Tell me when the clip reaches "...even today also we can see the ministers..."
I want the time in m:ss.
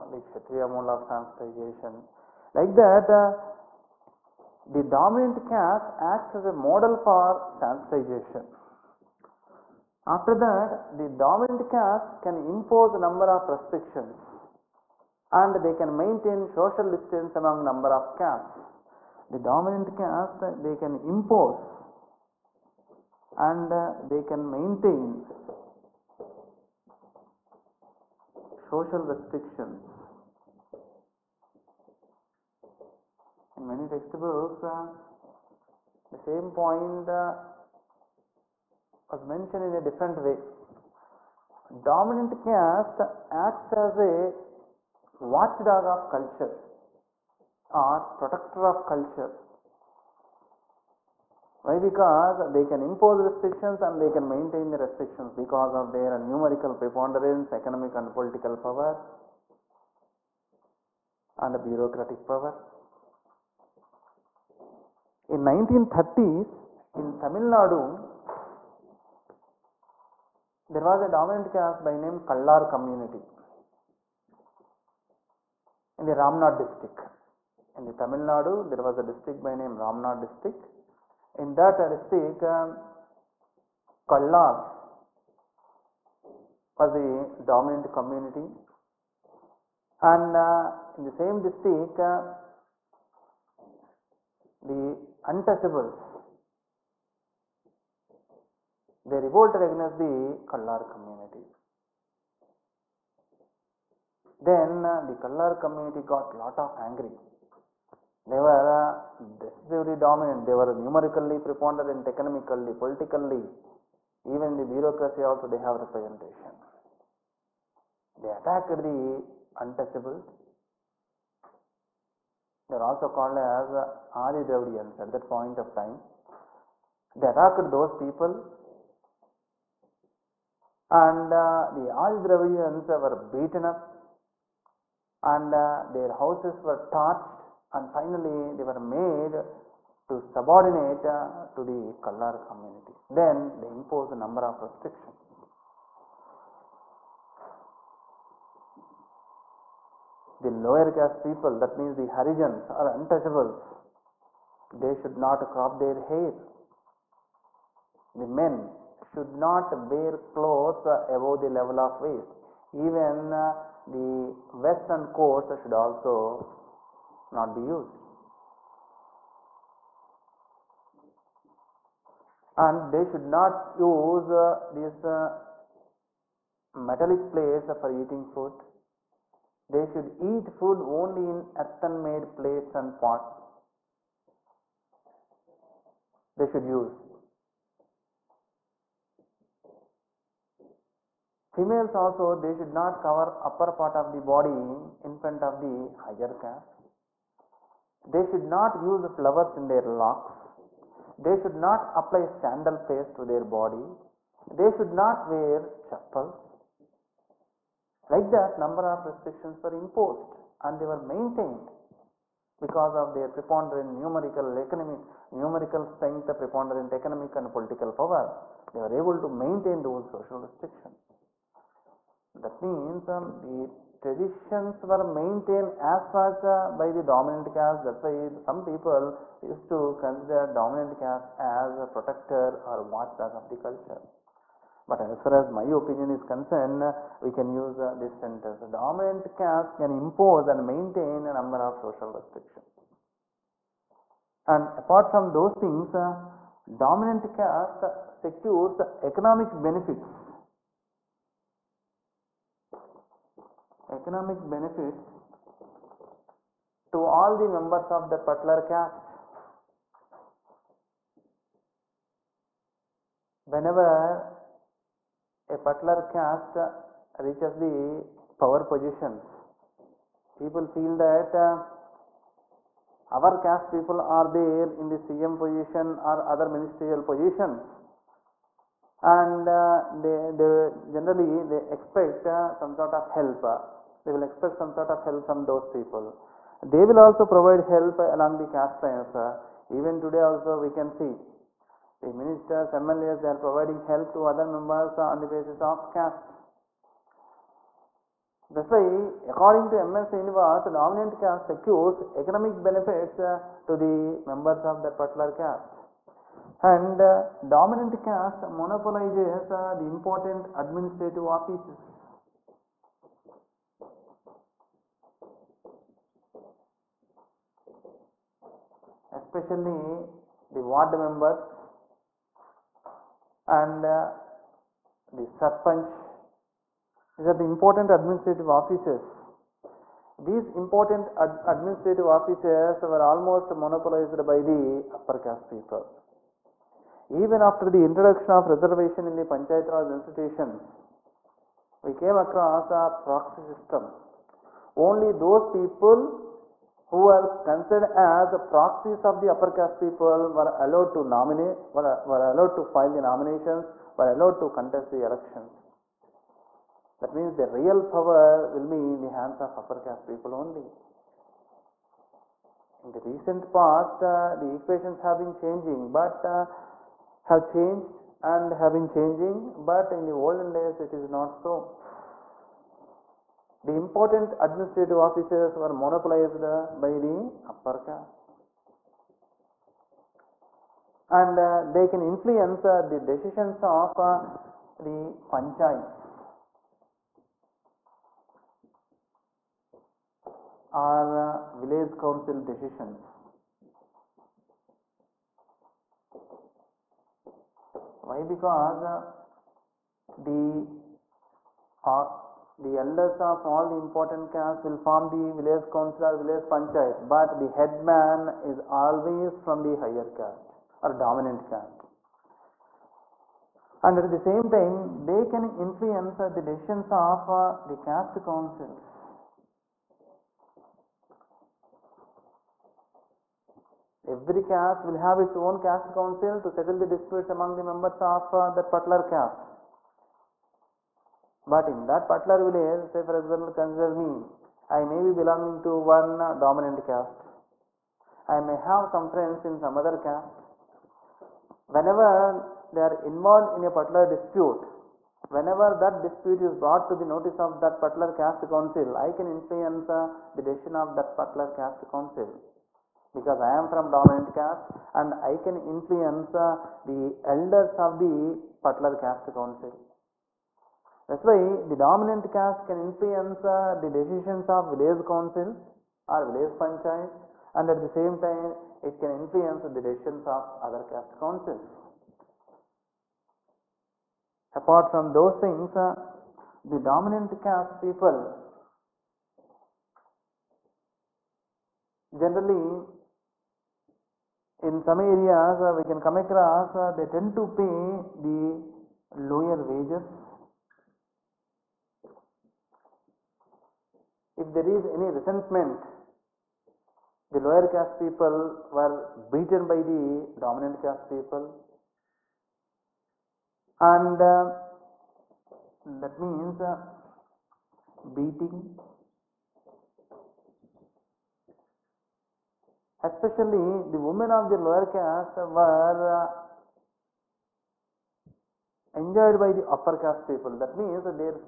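4:49.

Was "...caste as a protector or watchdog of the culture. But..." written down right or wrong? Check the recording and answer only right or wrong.
right.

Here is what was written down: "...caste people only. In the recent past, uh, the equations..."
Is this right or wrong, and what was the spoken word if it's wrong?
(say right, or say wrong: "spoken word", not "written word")
right.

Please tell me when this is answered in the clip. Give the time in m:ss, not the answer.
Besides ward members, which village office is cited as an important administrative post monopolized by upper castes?
5:25.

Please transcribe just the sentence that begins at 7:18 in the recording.
I may have some friends in some other caste.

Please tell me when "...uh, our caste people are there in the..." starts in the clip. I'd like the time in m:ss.
4:31.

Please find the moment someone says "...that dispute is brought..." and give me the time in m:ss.
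7:25.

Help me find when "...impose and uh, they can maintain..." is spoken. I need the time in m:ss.
0:21.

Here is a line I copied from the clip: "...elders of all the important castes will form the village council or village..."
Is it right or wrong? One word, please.
right.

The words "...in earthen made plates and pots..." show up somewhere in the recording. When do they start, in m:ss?
3:01.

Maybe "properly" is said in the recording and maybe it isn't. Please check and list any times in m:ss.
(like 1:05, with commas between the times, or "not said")
not said.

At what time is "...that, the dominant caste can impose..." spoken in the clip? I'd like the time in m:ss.
0:10.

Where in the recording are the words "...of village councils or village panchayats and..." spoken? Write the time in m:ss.
7:44.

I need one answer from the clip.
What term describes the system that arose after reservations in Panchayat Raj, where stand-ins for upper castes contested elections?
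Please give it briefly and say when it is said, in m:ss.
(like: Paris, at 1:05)
Proxy system, at 5:43.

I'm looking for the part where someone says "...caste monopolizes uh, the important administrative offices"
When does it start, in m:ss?
5:08.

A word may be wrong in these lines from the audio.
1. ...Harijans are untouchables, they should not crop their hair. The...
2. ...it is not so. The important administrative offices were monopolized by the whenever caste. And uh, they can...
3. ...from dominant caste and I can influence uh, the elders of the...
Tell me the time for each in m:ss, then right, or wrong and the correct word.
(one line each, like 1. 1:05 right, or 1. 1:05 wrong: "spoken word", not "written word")
1. 2:32 right
2. 6:10 wrong: "upper", not "whenever"
3. 7:33 right.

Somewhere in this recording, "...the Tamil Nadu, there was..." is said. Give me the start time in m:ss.
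1:17.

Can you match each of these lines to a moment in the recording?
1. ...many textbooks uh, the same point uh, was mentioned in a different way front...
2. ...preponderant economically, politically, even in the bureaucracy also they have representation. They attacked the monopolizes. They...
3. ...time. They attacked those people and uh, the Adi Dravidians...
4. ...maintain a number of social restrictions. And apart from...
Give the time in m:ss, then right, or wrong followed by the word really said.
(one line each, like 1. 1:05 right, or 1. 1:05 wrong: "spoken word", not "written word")
1. 0:33 wrong: "dominant", not "front"
2. 1:51 wrong: "untouchables", not "monopolizes"
3. 2:05 right
4. 4:00 right.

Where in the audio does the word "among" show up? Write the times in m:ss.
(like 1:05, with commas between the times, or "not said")
0:17, 7:07.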